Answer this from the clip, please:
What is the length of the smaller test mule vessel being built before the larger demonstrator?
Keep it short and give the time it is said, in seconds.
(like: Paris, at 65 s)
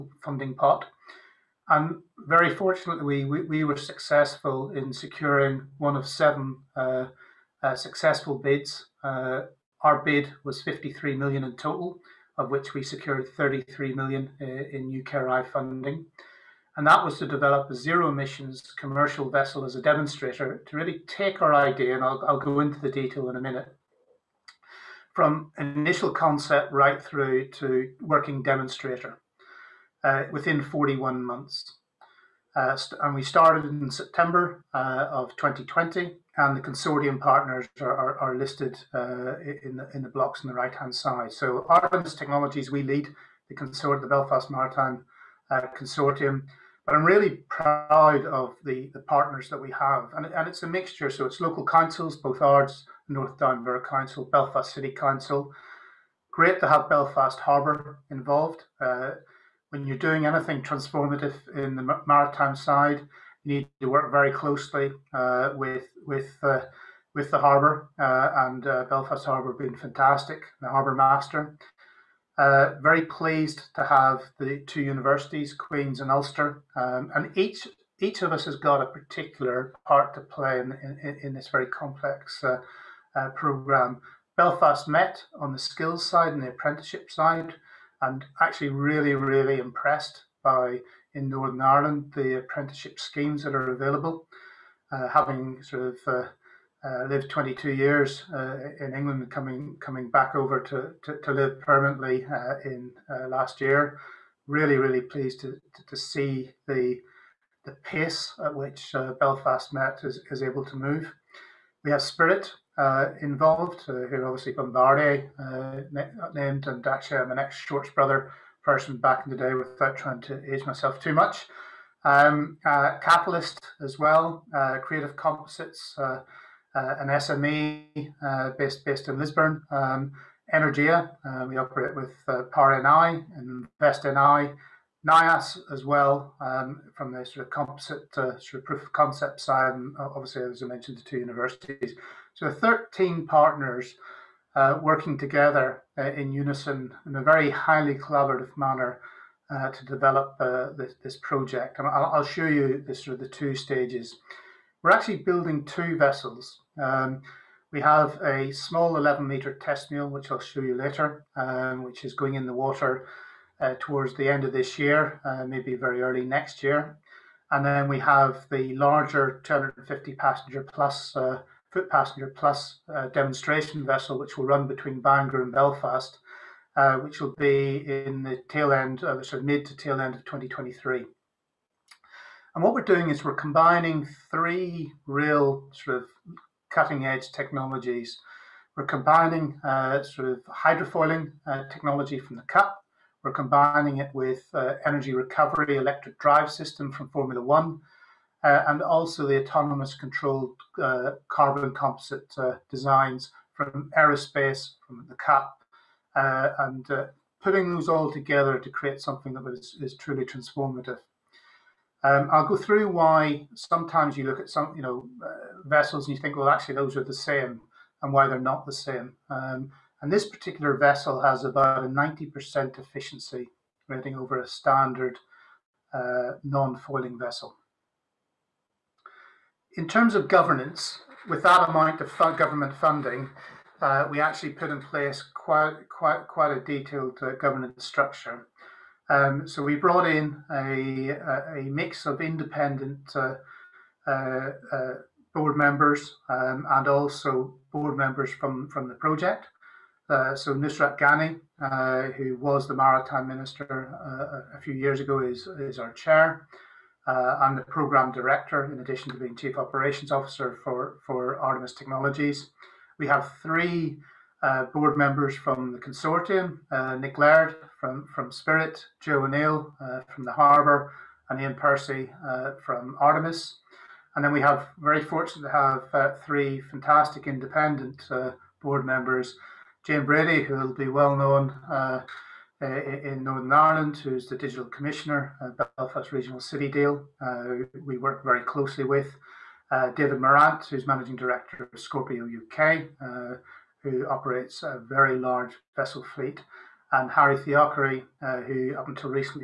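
11 meters, at 158 s.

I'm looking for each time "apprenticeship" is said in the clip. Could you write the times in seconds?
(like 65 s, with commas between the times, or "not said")
86 s, 92 s.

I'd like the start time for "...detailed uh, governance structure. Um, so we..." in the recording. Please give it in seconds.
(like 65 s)
236 s.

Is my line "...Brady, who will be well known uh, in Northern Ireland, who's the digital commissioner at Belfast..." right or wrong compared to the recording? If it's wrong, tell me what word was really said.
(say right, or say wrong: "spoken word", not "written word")
right.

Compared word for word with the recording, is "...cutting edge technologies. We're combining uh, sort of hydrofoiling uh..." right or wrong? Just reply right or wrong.
right.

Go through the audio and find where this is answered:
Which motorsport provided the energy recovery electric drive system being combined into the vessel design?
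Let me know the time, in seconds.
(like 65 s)
197 s.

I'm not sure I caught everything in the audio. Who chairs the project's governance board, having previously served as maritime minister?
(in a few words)
Nusrat Ghani.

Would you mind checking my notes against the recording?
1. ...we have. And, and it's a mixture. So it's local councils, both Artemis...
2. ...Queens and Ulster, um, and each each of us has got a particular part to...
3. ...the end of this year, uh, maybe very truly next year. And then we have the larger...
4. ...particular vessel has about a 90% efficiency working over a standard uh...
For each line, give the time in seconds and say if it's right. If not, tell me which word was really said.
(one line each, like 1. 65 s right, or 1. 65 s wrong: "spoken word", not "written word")
1. 49 s wrong: "Ards", not "Artemis"
2. 75 s right
3. 164 s wrong: "early", not "truly"
4. 220 s wrong: "rating", not "working".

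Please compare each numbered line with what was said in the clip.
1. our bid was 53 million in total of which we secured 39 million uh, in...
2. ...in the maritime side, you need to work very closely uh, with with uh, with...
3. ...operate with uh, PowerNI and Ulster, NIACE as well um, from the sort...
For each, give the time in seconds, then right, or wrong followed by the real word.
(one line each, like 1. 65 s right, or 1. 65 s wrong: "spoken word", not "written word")
1. 9 s wrong: "33", not "39"
2. 61 s right
3. 131 s wrong: "InvestNI", not "Ulster".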